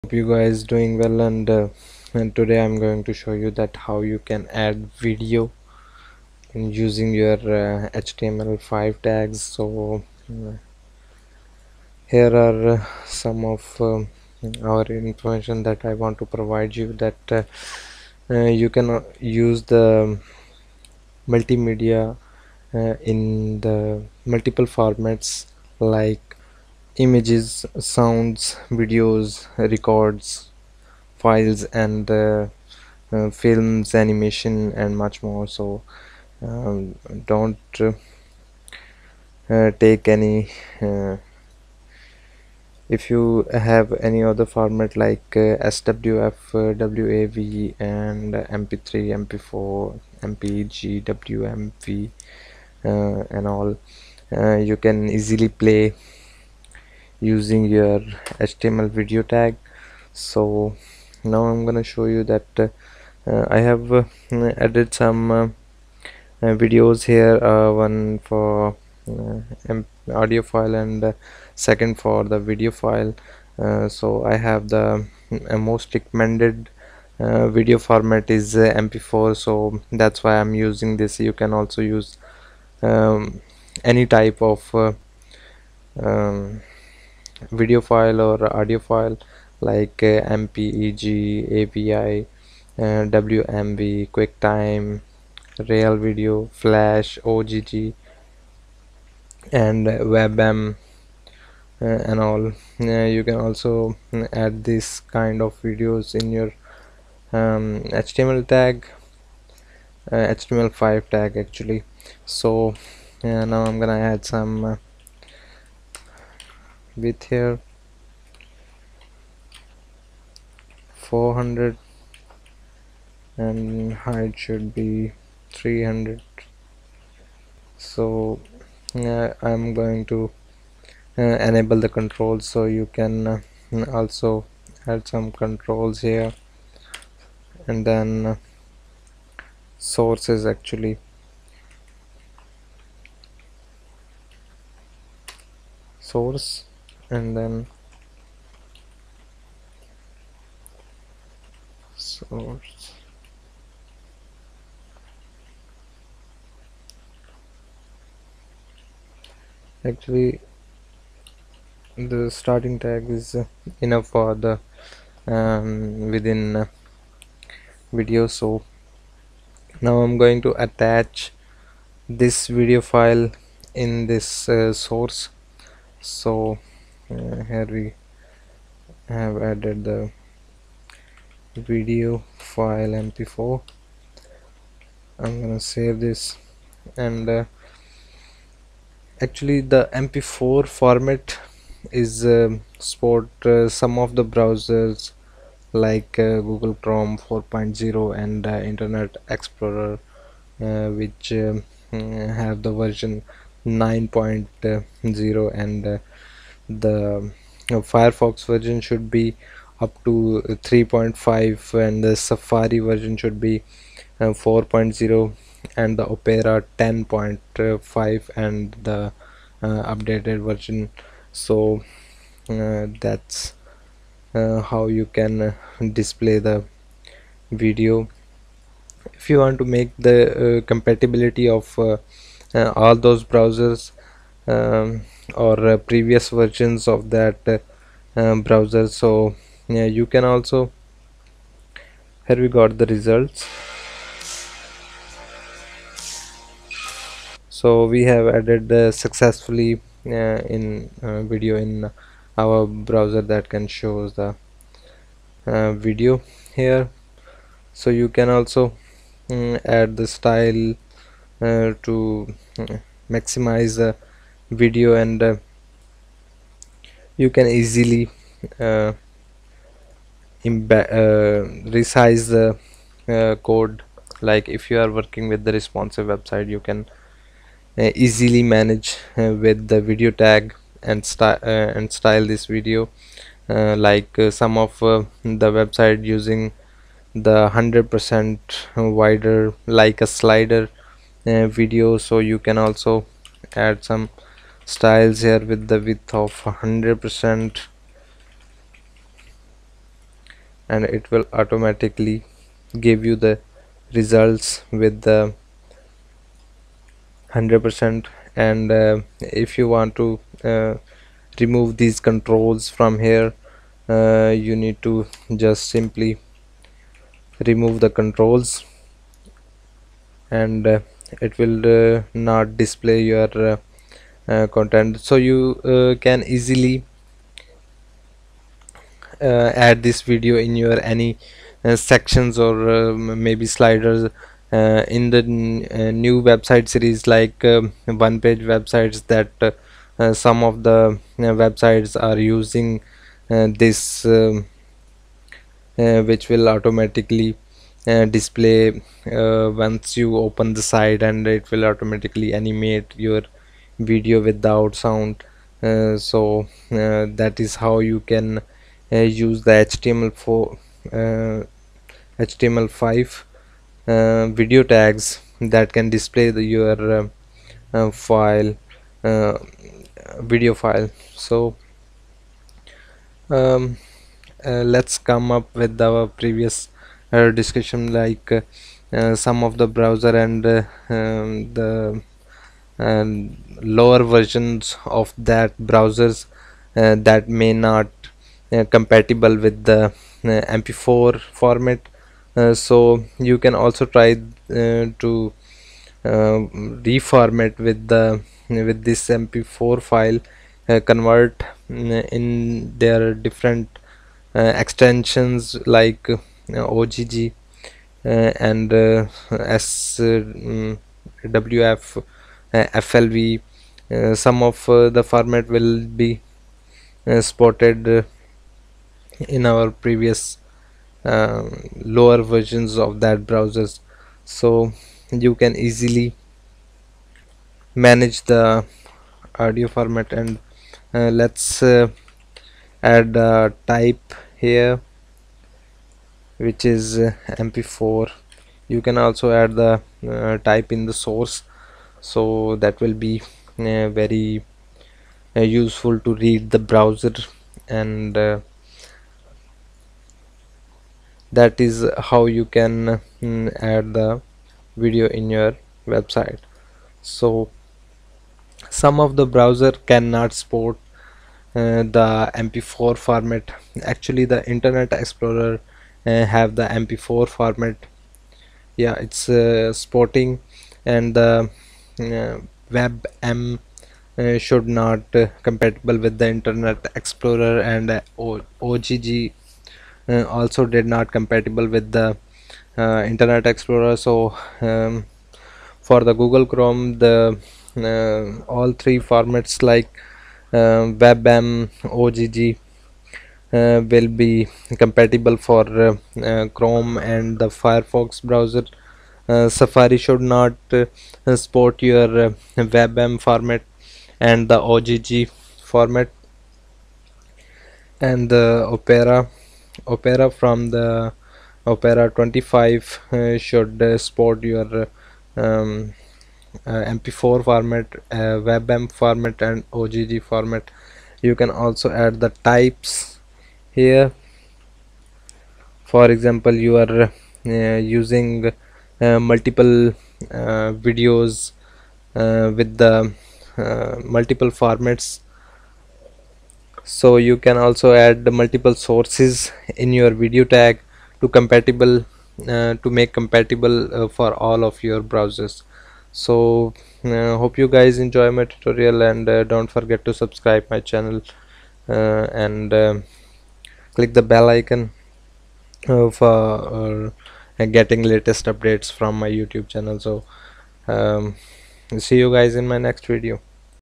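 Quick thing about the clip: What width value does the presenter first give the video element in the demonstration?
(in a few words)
400.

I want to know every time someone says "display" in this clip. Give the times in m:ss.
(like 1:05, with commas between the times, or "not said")
3:45, 5:22, 5:48, 6:05.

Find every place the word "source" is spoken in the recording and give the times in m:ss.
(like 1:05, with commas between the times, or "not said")
2:19, 2:26, 2:32, 2:54, 7:20, 8:58.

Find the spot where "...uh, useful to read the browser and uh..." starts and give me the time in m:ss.
7:25.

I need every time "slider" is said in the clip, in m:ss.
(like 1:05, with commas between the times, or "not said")
4:50, 5:33.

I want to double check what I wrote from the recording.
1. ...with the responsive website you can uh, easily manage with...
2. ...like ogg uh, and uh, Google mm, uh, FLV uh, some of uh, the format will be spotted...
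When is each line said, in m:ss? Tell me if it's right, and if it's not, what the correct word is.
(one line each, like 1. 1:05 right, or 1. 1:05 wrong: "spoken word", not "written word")
1. 4:35 right
2. 6:45 wrong: "SWF", not "Google".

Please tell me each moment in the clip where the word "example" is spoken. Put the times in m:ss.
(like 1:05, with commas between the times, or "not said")
8:46.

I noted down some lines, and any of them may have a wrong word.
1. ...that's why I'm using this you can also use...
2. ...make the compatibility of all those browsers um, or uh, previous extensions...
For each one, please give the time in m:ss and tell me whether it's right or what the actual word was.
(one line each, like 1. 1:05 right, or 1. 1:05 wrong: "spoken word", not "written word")
1. 1:19 right
2. 3:49 wrong: "versions", not "extensions".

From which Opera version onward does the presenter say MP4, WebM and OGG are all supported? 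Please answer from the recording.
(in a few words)
Opera 25.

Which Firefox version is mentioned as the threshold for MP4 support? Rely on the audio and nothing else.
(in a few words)
3.5.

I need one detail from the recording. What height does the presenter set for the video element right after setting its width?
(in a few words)
300.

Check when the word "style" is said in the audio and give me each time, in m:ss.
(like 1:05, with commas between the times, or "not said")
4:20, 4:41, 4:54.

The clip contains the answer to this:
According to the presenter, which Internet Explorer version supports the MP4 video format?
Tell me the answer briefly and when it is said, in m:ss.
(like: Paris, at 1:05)
9.0, at 3:23.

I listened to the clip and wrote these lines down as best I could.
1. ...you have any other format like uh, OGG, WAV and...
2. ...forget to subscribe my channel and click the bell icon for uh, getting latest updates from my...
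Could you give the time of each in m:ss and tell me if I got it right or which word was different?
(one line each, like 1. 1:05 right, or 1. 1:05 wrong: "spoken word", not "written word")
1. 0:43 wrong: "SWF", not "OGG"
2. 9:09 right.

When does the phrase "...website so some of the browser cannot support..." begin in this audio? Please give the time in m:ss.
7:35.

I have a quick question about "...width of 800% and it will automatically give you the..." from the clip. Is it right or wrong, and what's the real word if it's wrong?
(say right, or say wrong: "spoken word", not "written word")
wrong: "100", not "800".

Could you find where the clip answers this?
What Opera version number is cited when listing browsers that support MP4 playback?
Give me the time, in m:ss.
3:36.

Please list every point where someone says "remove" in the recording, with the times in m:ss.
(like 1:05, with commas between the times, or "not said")
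5:11, 5:17.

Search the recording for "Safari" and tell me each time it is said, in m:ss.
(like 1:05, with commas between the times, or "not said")
3:32, 8:19.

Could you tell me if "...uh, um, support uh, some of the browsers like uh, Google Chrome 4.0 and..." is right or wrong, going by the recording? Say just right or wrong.
right.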